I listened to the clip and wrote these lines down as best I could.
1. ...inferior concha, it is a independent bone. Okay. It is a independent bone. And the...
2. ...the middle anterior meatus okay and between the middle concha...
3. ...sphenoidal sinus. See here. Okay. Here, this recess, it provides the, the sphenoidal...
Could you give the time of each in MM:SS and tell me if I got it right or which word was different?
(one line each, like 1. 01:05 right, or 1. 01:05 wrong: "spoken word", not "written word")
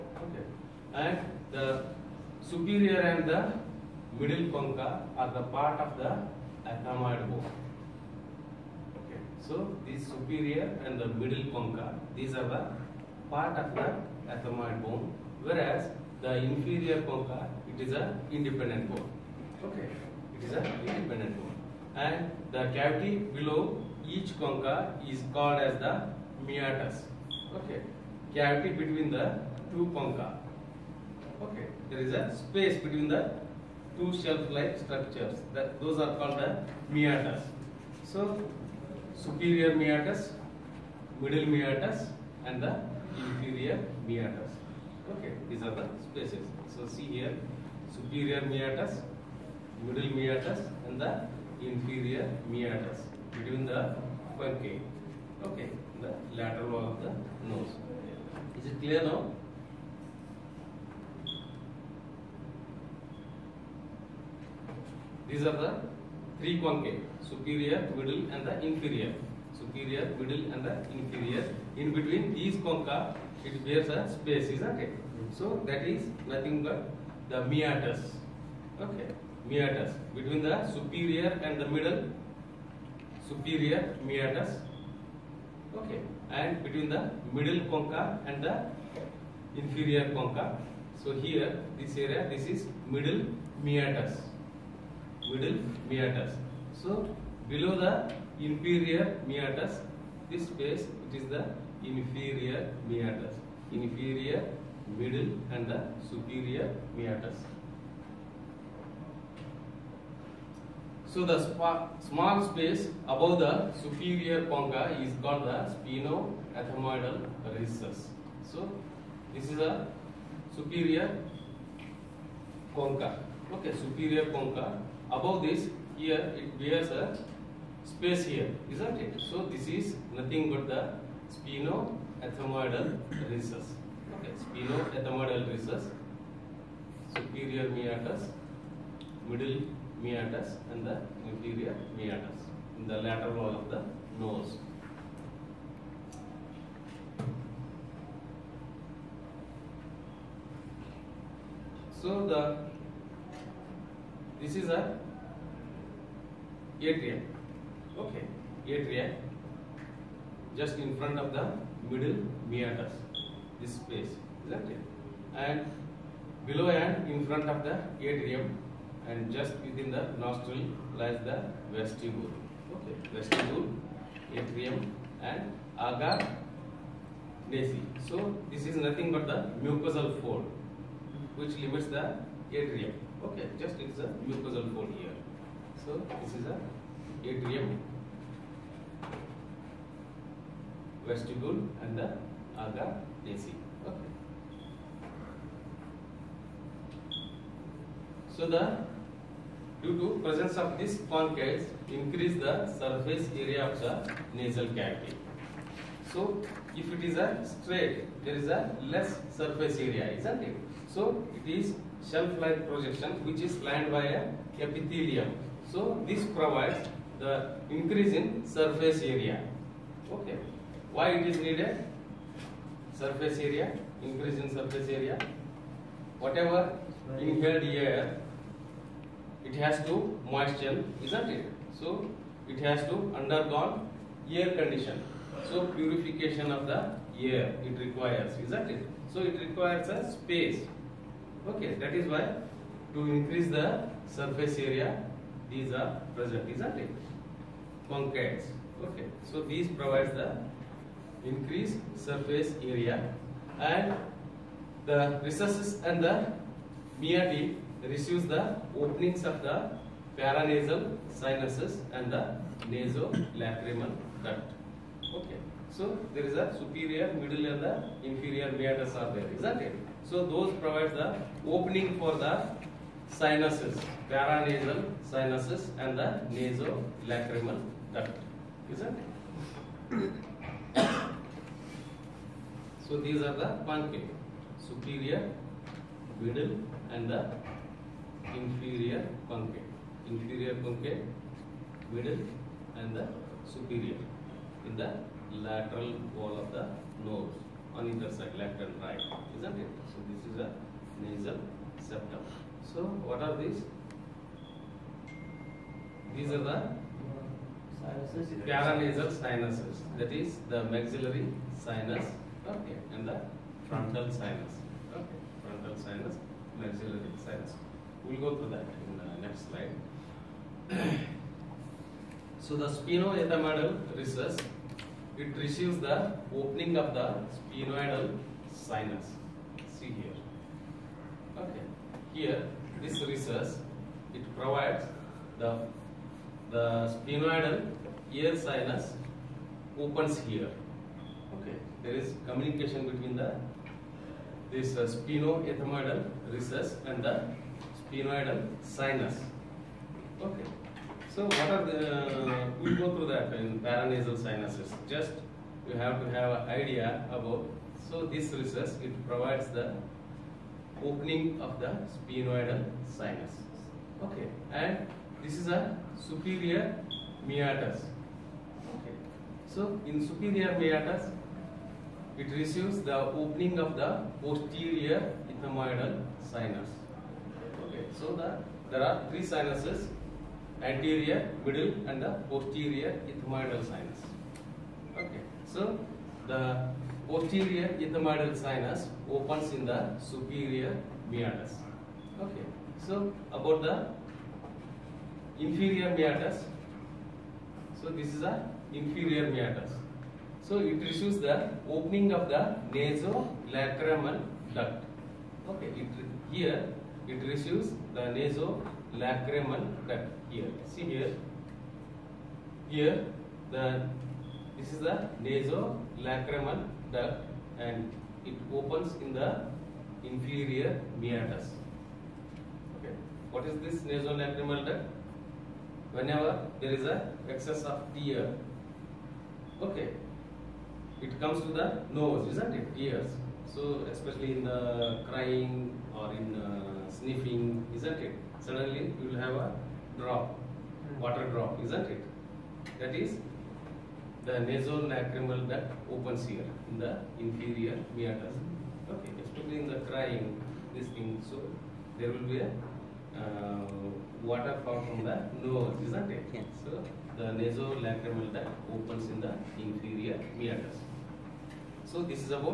1. 00:16 right
2. 01:21 wrong: "superior", not "anterior"
3. 05:27 right.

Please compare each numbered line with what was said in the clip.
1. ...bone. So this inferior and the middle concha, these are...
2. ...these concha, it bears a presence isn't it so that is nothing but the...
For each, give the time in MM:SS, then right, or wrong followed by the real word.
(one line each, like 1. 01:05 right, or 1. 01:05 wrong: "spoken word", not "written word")
1. 00:07 wrong: "superior", not "inferior"
2. 01:12 wrong: "space", not "presence".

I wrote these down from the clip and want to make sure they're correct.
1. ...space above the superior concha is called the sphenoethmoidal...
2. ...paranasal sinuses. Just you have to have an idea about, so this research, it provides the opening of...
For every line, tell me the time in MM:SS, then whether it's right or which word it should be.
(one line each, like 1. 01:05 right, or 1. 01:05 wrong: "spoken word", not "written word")
1. 01:52 right
2. 05:53 right.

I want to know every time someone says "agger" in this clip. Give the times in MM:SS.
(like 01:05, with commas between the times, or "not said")
02:55, 03:12.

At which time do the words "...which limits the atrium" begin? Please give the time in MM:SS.
03:01.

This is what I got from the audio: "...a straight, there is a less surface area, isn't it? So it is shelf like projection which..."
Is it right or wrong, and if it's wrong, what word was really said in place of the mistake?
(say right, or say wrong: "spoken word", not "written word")
right.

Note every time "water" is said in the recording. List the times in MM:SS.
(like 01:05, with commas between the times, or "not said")
07:21, 07:34.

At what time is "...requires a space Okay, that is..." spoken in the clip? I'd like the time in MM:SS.
03:59.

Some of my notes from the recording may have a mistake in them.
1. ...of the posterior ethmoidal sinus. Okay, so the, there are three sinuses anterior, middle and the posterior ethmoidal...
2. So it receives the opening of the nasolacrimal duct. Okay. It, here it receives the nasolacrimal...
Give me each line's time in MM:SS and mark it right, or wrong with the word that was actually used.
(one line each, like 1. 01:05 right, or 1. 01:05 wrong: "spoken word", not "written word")
1. 06:13 right
2. 06:40 right.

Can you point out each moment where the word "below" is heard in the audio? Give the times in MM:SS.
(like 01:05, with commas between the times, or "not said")
00:23, 01:37, 02:46.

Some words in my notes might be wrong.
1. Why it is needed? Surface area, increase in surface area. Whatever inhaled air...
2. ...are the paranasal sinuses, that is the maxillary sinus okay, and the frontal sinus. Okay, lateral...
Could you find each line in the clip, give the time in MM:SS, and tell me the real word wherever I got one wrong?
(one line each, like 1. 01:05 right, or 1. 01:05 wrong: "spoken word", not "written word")
1. 03:40 right
2. 05:06 wrong: "frontal", not "lateral".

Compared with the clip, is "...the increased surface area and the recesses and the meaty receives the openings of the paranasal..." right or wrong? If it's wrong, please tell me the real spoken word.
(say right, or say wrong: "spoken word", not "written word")
right.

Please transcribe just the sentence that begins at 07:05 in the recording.
Whenever there is a excess of tear, okay, it comes to the nose, isn't it?